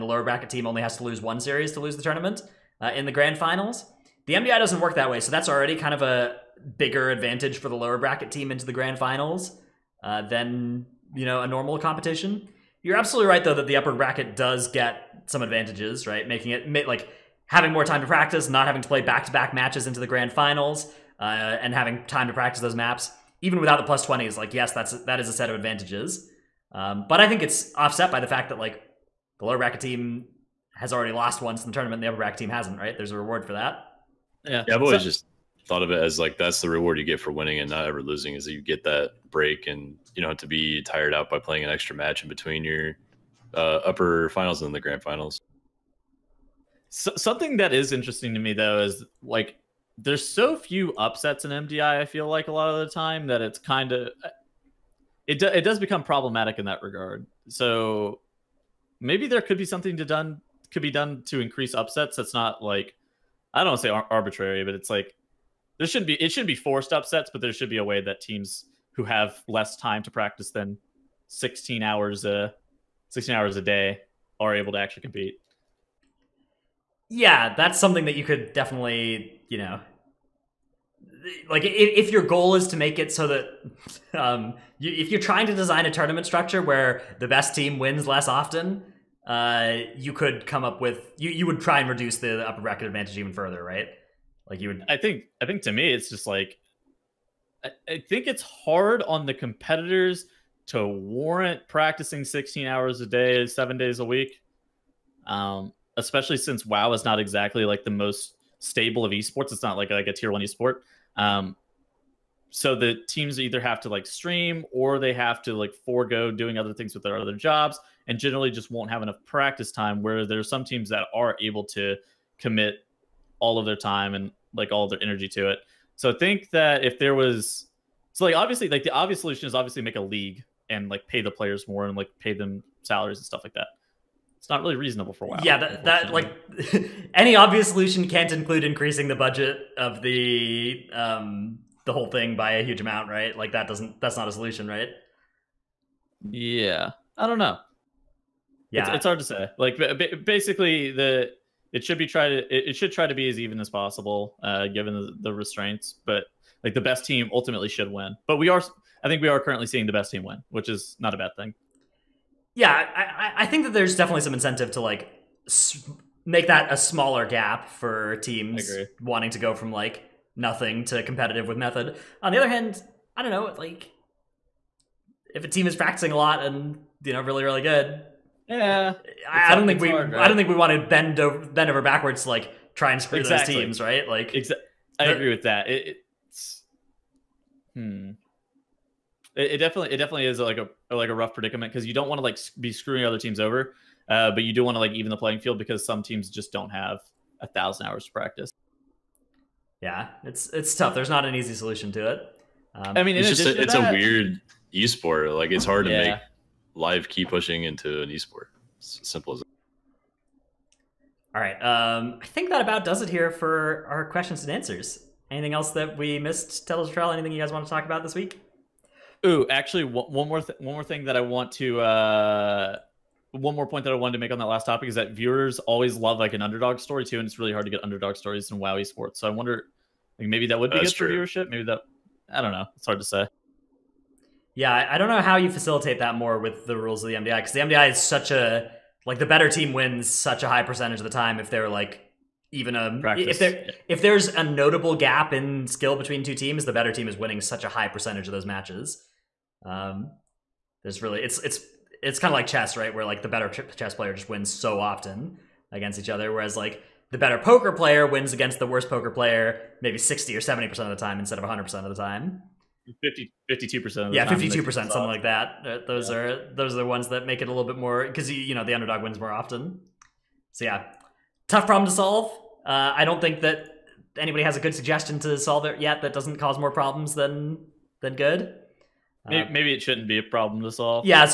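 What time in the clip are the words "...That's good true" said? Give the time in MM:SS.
03:50.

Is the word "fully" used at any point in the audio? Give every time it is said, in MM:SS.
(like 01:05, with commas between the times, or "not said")
not said.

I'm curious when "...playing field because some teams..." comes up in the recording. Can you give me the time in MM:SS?
03:15.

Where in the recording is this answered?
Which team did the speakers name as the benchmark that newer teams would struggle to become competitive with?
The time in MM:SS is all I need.
02:51.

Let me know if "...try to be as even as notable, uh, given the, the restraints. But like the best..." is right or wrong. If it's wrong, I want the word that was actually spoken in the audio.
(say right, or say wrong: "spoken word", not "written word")
wrong: "possible", not "notable".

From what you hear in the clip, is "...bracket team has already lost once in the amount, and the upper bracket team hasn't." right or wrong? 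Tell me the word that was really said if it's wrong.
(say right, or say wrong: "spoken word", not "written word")
wrong: "tournament", not "amount".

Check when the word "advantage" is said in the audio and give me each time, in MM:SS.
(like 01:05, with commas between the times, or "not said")
00:07, 00:15, 00:25, 01:32.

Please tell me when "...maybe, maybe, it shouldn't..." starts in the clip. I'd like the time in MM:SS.
04:39.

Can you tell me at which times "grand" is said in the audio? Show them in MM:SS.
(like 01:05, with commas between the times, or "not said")
00:03, 00:08, 00:20, 00:44.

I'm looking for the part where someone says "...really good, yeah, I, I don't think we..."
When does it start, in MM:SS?
02:57.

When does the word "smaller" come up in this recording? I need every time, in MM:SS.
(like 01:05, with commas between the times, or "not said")
02:46.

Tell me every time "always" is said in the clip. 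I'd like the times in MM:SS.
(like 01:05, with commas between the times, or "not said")
00:34, 03:45.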